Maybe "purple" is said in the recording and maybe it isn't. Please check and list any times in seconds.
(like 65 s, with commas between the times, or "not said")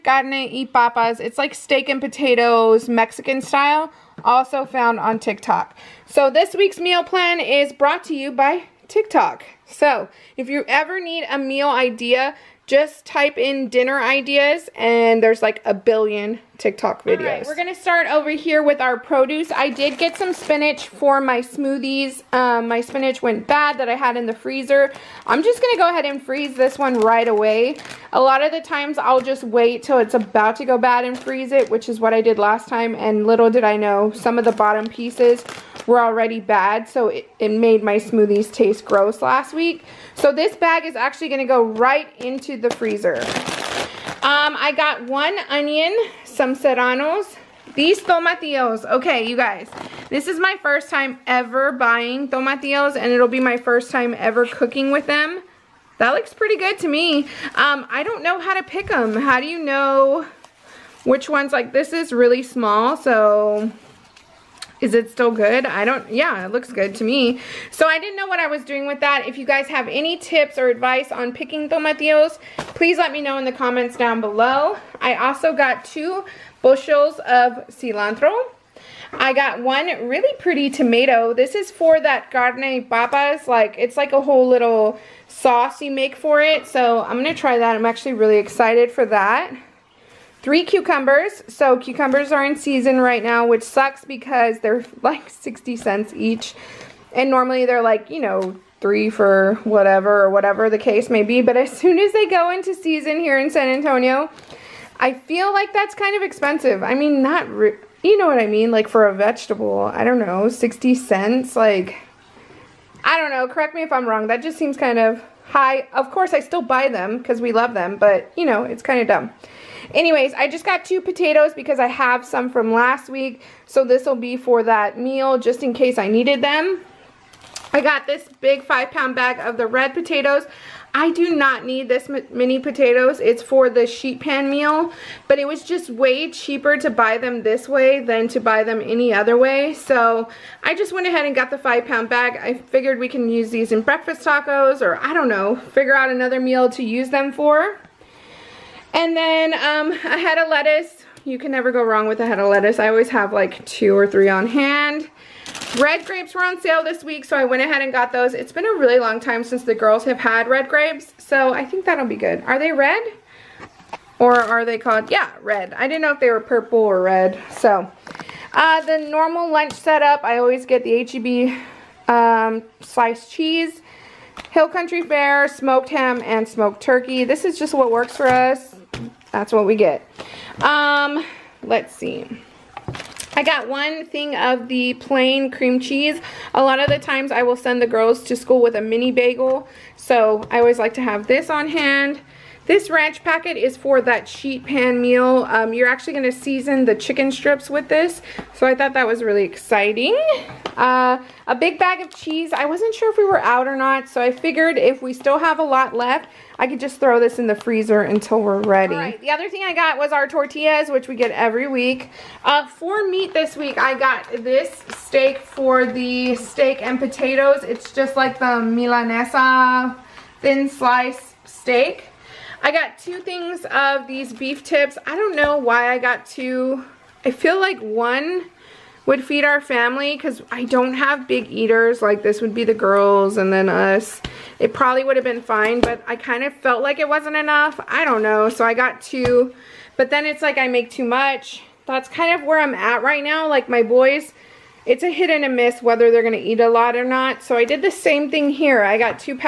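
166 s.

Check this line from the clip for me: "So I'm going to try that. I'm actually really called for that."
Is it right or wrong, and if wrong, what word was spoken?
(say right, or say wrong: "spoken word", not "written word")
wrong: "excited", not "called".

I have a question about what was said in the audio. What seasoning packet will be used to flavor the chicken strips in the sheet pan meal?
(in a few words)
ranch packet.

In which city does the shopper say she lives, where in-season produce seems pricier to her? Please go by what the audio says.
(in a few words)
San Antonio.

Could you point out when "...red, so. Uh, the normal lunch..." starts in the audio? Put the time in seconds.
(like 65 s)
167 s.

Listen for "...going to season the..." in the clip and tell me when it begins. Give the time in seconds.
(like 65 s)
196 s.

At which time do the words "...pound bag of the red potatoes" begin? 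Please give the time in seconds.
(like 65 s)
128 s.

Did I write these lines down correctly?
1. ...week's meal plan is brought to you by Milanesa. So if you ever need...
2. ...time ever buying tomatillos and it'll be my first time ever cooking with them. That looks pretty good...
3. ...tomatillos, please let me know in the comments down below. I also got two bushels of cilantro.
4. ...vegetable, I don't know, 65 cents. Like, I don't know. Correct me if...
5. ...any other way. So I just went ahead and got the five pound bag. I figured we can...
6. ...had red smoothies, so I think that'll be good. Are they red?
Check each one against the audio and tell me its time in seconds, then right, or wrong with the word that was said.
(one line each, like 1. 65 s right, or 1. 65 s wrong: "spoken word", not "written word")
1. 6 s wrong: "TikTok", not "Milanesa"
2. 50 s right
3. 71 s right
4. 109 s wrong: "60", not "65"
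5. 138 s right
6. 160 s wrong: "grapes", not "smoothies".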